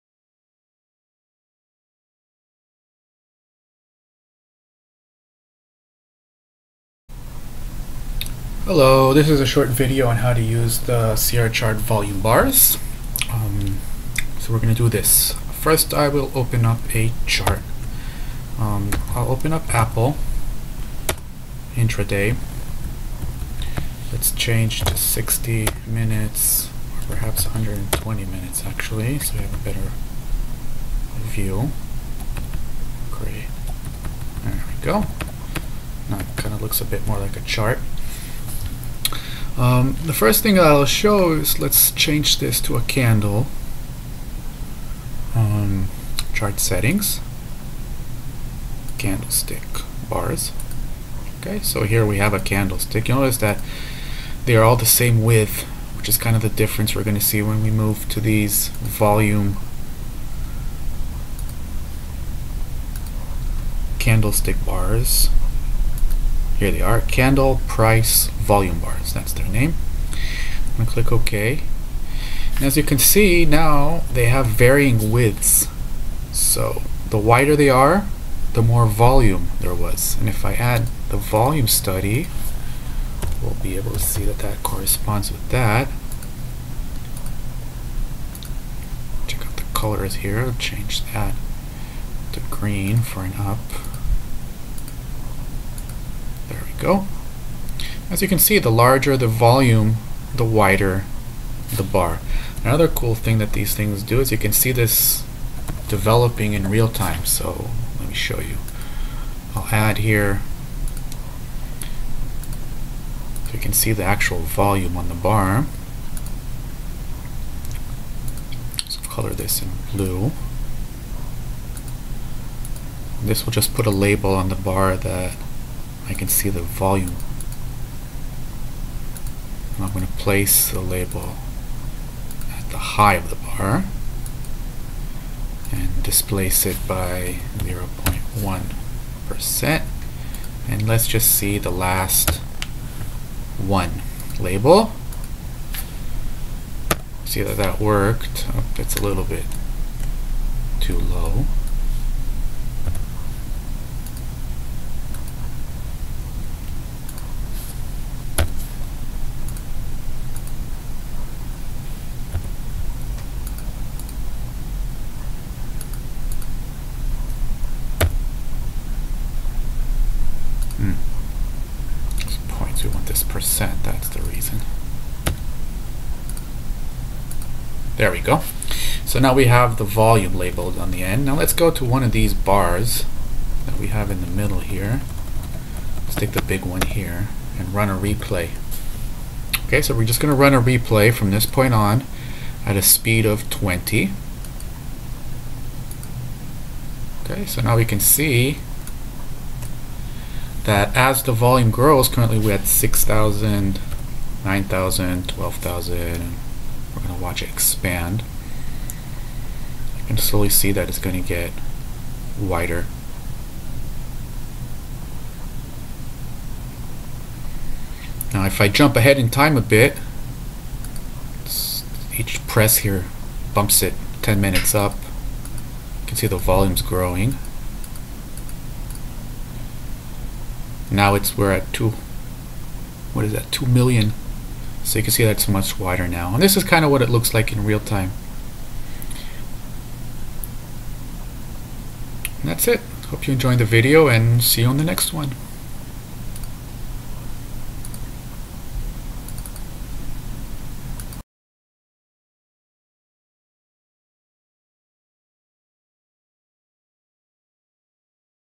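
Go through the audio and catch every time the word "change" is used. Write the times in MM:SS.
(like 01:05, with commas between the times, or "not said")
00:24, 00:41, 01:30.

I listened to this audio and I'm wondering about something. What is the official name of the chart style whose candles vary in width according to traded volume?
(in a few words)
Candle Price Volume Bars.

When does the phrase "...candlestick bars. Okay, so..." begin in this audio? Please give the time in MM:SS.
00:48.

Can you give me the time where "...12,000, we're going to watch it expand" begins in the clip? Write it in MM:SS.
03:25.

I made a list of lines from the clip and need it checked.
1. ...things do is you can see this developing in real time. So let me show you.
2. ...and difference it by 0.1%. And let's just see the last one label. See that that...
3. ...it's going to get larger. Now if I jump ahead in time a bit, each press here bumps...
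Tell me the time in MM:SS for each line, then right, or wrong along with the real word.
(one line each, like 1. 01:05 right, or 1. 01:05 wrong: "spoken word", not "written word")
1. 01:43 right
2. 02:15 wrong: "displace", not "difference"
3. 03:30 wrong: "wider", not "larger".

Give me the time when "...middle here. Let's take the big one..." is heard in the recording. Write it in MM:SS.
03:04.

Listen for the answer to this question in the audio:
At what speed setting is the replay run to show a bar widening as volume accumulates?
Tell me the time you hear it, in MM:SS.
03:13.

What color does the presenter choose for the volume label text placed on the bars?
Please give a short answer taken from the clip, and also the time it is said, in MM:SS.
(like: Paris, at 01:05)
blue, at 01:59.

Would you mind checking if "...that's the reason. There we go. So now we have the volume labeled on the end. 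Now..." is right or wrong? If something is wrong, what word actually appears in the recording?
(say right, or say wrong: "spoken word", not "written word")
right.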